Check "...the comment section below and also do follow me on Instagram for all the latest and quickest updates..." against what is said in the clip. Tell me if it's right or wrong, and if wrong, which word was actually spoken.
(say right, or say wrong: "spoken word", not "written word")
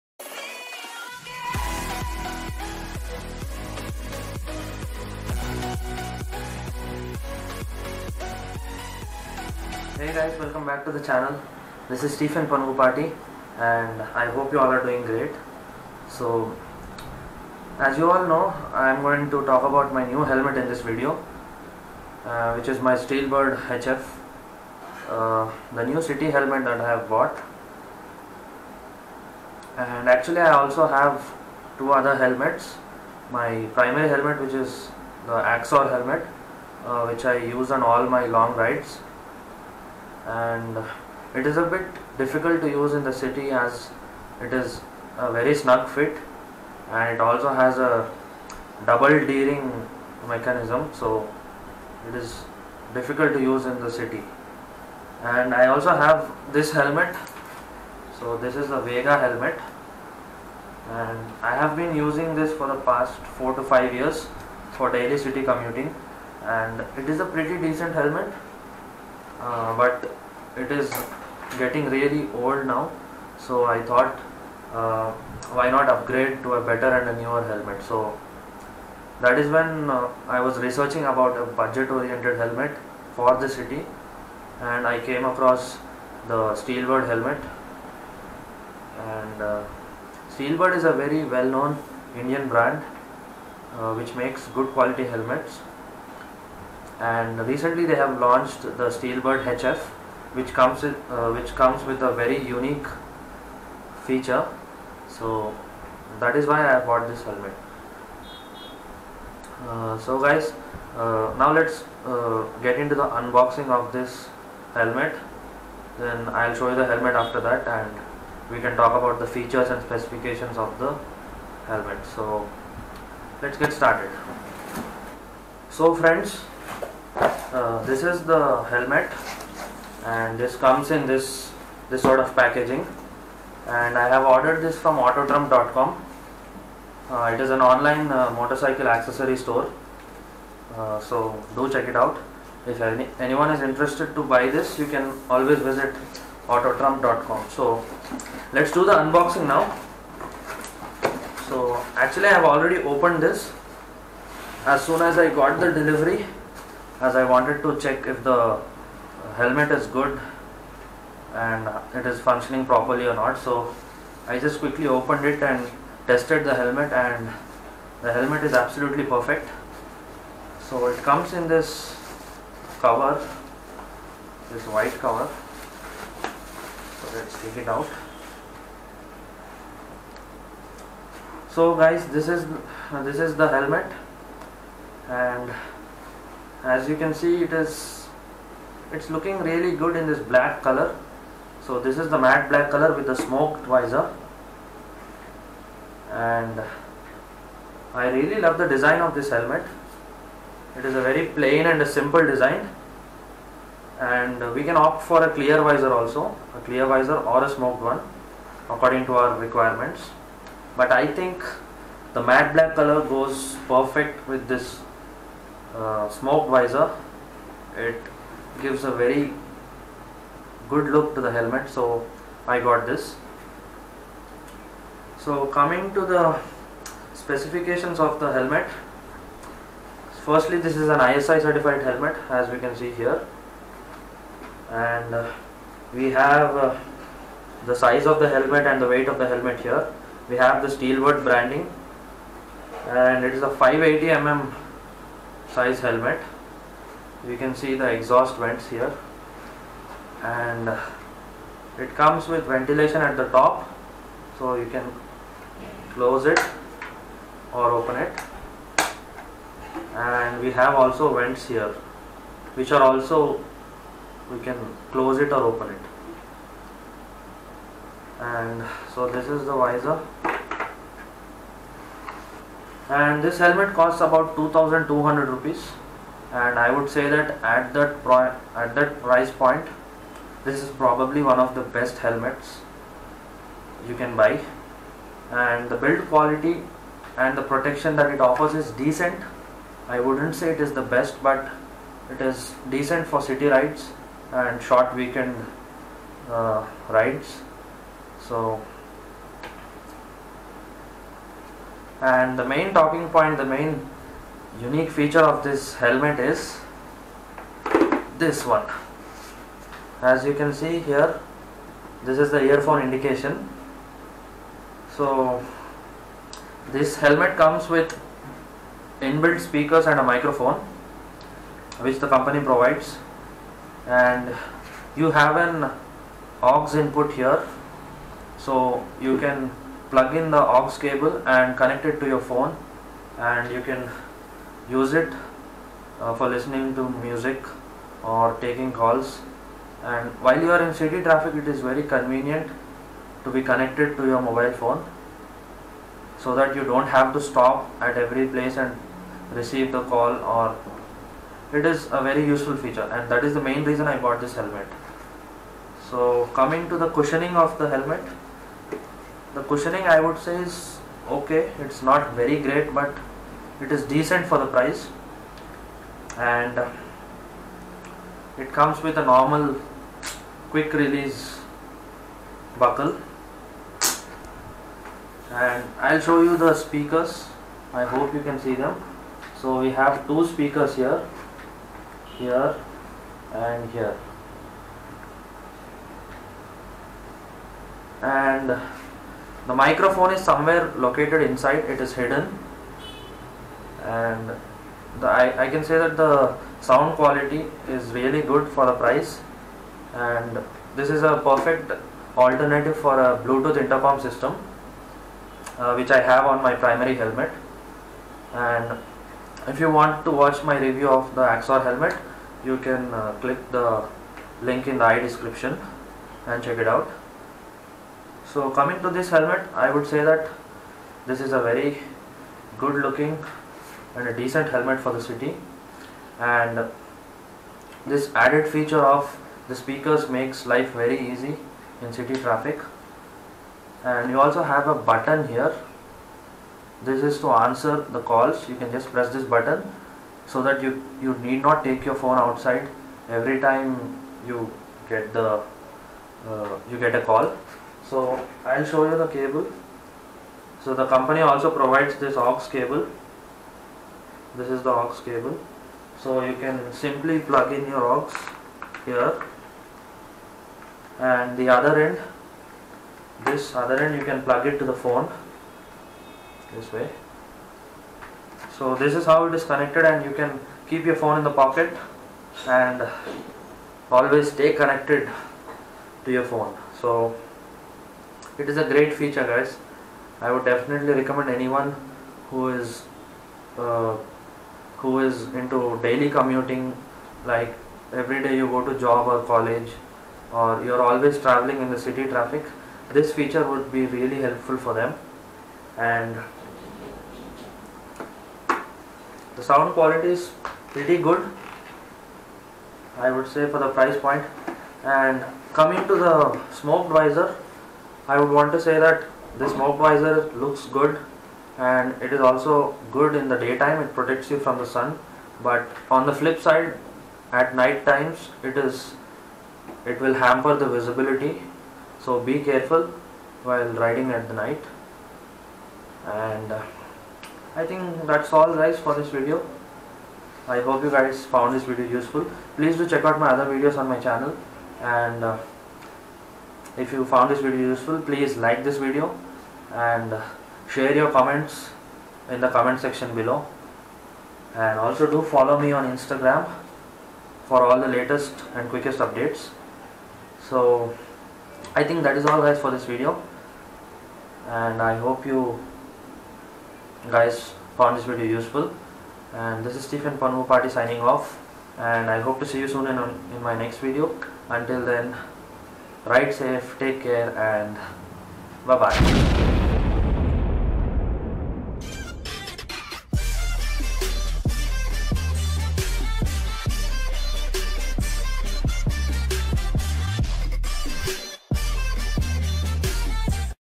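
right.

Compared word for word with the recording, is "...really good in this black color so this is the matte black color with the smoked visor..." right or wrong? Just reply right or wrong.
right.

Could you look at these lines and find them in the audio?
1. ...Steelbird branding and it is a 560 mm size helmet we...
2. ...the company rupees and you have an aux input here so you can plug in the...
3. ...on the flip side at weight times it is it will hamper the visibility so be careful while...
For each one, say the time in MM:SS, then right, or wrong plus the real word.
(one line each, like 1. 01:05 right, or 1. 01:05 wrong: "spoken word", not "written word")
1. 04:00 wrong: "580", not "560"
2. 05:21 wrong: "provides", not "rupees"
3. 08:35 wrong: "night", not "weight".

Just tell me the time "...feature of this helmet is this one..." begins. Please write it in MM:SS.
05:04.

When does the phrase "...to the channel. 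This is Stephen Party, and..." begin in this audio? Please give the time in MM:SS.
00:10.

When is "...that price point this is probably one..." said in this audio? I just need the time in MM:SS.
04:38.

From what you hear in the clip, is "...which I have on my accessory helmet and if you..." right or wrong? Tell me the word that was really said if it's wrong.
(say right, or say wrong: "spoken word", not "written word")
wrong: "primary", not "accessory".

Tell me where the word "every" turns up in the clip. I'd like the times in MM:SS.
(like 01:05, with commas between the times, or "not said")
05:48, 07:23, 08:07.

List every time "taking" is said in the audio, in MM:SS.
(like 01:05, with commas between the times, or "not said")
05:38.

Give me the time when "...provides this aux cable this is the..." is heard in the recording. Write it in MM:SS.
07:31.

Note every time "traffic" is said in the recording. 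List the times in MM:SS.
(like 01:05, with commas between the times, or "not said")
05:41, 07:12, 08:12.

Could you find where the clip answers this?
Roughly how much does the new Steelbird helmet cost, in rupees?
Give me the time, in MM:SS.
04:34.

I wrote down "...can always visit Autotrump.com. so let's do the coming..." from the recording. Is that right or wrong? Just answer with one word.
wrong.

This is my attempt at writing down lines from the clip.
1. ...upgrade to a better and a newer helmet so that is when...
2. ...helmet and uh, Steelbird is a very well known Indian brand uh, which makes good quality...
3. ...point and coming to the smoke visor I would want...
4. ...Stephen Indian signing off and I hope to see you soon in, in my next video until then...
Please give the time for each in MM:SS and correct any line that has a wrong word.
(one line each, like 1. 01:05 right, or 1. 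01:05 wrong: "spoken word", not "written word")
1. 01:15 right
2. 01:27 right
3. 08:23 right
4. 09:19 wrong: "Party", not "Indian".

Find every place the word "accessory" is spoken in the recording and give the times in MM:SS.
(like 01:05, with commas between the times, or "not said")
02:18.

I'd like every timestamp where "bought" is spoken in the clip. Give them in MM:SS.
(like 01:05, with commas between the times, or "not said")
00:27, 01:46, 05:54.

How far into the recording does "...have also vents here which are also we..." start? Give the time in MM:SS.
04:20.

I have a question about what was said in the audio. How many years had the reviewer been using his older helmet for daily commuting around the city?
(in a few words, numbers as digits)
4 to 5 years.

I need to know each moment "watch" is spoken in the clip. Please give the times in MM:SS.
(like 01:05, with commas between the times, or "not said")
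06:50.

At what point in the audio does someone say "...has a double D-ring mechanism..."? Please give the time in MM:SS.
00:47.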